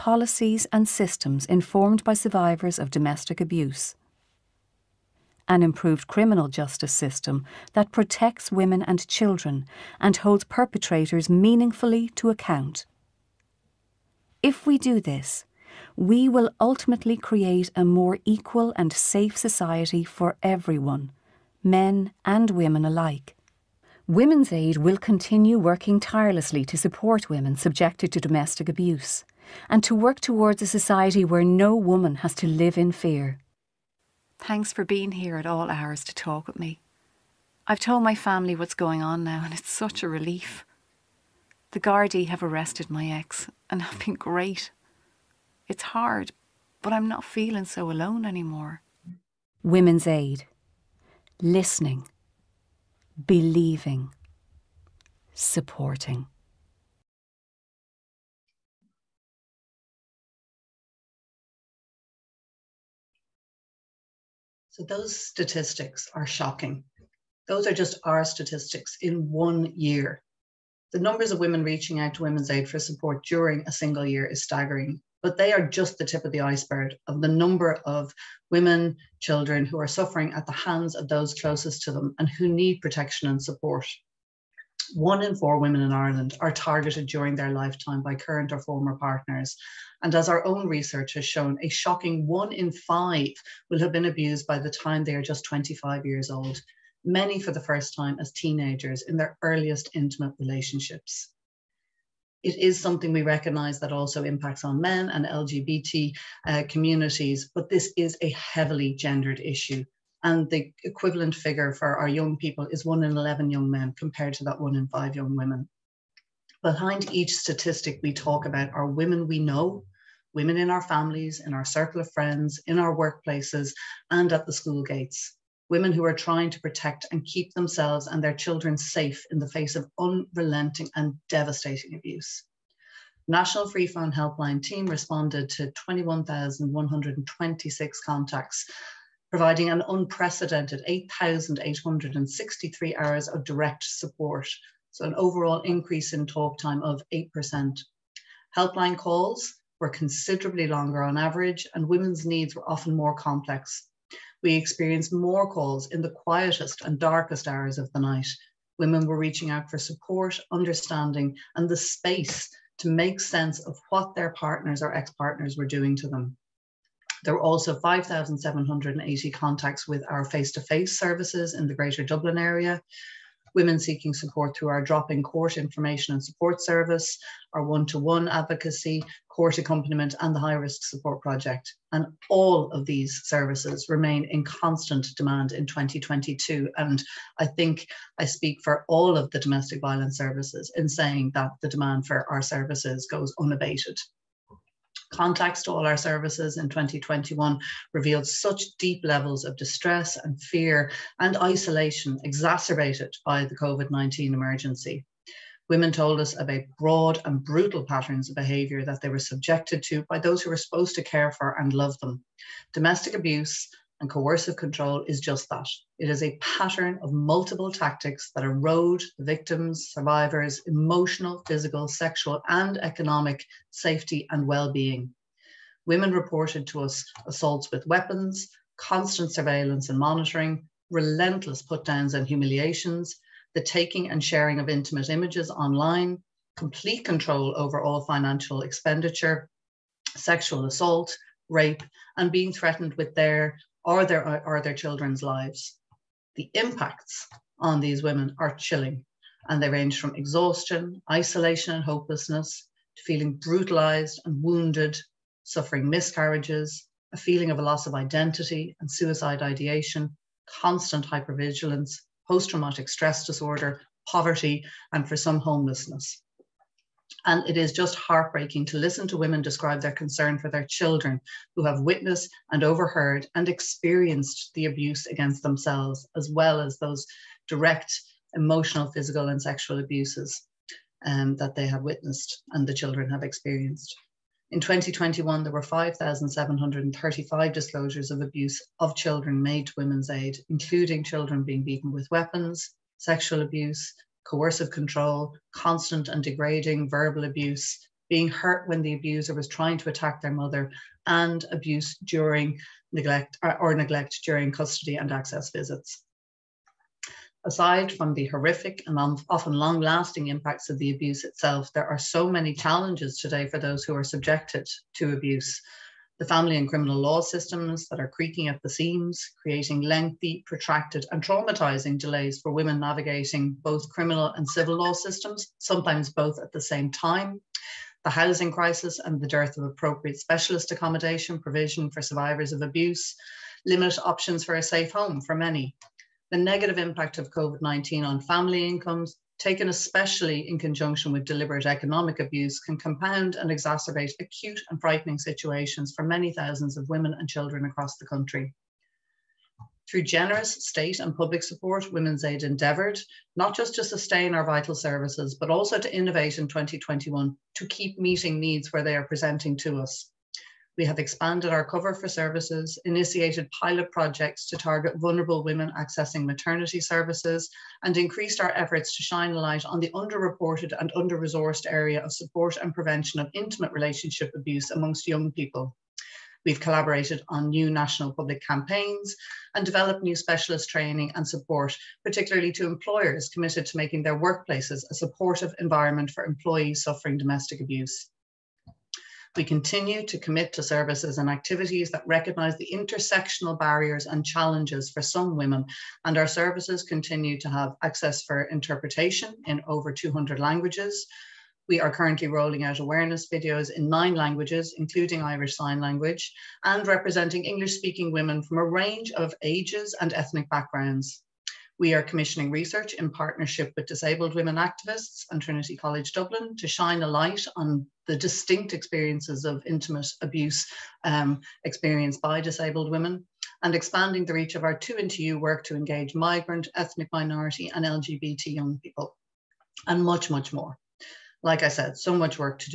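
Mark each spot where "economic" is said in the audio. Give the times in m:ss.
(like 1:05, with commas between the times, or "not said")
3:42, 5:41.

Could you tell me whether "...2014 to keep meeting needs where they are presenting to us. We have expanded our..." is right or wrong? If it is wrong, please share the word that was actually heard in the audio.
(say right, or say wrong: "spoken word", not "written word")
wrong: "2021", not "2014".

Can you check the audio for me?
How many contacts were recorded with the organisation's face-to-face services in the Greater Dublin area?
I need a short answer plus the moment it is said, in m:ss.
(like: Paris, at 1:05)
5,780, at 2:47.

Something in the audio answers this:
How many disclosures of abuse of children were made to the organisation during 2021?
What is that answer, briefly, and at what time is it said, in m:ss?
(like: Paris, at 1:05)
5,735, at 4:45.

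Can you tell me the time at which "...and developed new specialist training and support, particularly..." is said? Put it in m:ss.
6:19.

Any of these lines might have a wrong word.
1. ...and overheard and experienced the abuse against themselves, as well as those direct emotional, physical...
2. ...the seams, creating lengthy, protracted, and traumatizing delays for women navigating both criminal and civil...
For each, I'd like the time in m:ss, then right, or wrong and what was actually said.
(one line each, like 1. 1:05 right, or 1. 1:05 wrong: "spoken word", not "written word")
1. 4:32 right
2. 5:18 right.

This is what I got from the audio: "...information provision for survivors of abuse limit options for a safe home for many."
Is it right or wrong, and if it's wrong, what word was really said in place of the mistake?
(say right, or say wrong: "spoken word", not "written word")
wrong: "accommodation", not "information".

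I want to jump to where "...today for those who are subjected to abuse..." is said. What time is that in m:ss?
5:13.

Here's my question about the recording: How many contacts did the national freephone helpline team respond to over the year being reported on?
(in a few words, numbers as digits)
21,126.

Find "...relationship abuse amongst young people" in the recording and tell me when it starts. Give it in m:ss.
6:13.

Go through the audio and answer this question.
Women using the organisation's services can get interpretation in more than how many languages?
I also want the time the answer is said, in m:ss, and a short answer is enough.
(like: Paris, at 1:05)
200, at 6:39.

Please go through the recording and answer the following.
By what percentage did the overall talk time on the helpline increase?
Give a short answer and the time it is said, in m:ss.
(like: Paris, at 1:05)
8%, at 2:27.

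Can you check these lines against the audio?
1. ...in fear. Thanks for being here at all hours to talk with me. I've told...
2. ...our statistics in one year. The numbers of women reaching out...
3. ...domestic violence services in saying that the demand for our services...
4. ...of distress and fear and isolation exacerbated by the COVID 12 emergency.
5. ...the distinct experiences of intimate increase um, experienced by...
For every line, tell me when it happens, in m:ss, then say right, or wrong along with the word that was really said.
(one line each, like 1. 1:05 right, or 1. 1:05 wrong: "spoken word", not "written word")
1. 0:32 right
2. 1:08 right
3. 3:09 right
4. 3:19 wrong: "19", not "12"
5. 6:58 wrong: "abuse", not "increase".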